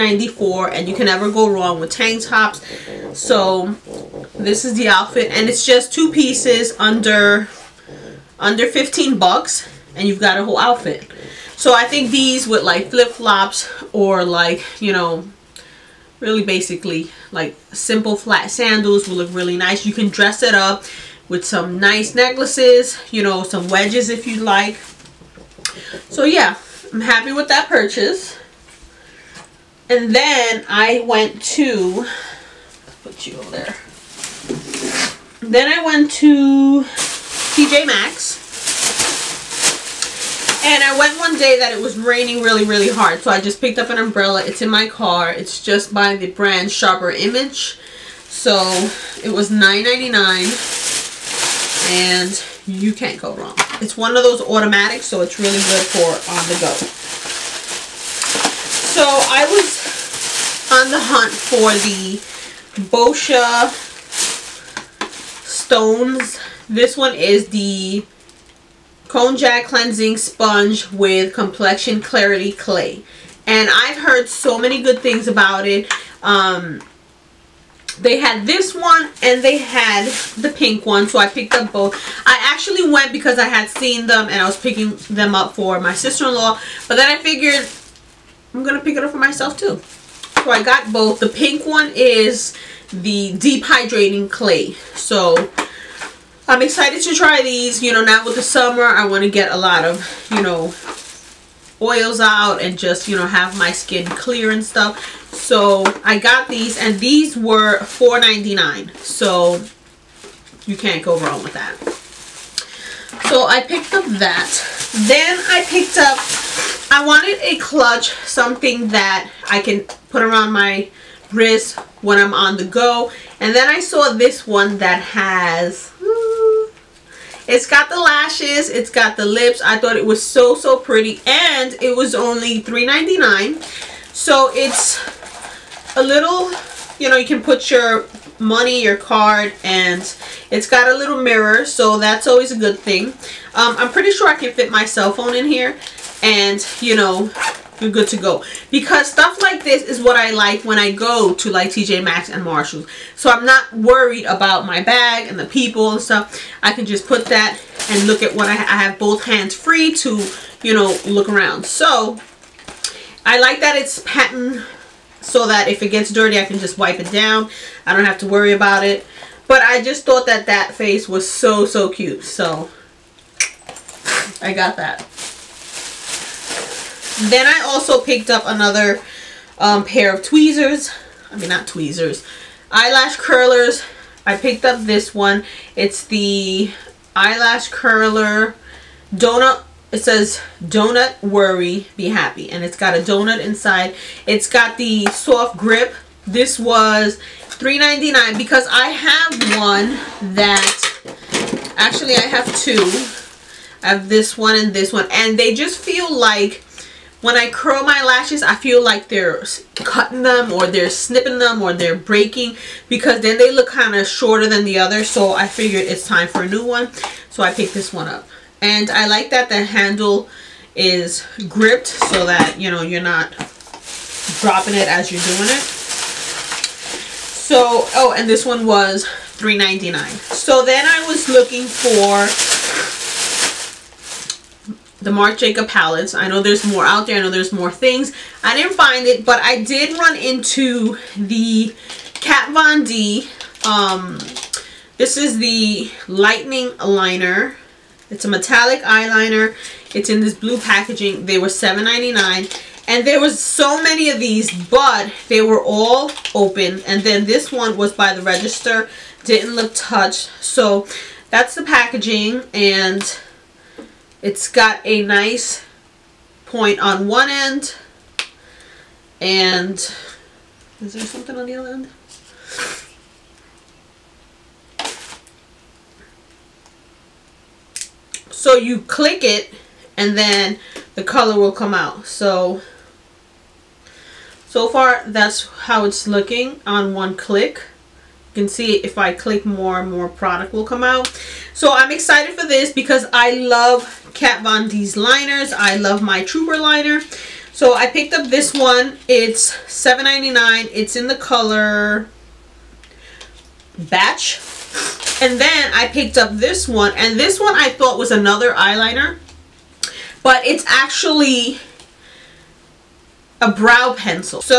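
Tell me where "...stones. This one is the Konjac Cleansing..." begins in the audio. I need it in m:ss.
1:05.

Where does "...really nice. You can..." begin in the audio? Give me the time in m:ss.
0:19.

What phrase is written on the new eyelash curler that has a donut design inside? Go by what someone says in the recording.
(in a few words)
donut worry be happy.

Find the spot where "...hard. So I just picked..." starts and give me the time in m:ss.
0:42.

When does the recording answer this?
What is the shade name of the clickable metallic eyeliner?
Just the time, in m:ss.
5:03.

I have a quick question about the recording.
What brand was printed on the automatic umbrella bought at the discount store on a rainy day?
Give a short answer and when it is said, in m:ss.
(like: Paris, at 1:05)
Sharper Image, at 0:46.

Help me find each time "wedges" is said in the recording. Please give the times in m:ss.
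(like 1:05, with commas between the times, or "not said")
0:23.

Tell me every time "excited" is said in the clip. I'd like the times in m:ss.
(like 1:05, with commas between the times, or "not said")
1:36, 4:51.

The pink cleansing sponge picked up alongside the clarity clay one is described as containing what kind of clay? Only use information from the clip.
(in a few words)
deep hydrating clay.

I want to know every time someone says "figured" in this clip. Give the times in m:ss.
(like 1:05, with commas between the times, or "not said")
1:27, 3:35.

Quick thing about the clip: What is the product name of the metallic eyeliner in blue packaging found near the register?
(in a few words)
Lightning Liner.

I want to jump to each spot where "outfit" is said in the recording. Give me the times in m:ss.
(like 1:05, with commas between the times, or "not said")
0:04, 0:10.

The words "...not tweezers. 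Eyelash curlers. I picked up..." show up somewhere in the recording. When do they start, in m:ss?
3:01.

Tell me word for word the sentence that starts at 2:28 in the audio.
Because stuff like this is what I like when I go to, like, TJ Maxx and Marshalls.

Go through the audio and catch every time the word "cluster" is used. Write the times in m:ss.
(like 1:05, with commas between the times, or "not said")
not said.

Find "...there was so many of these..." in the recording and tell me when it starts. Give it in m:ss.
4:13.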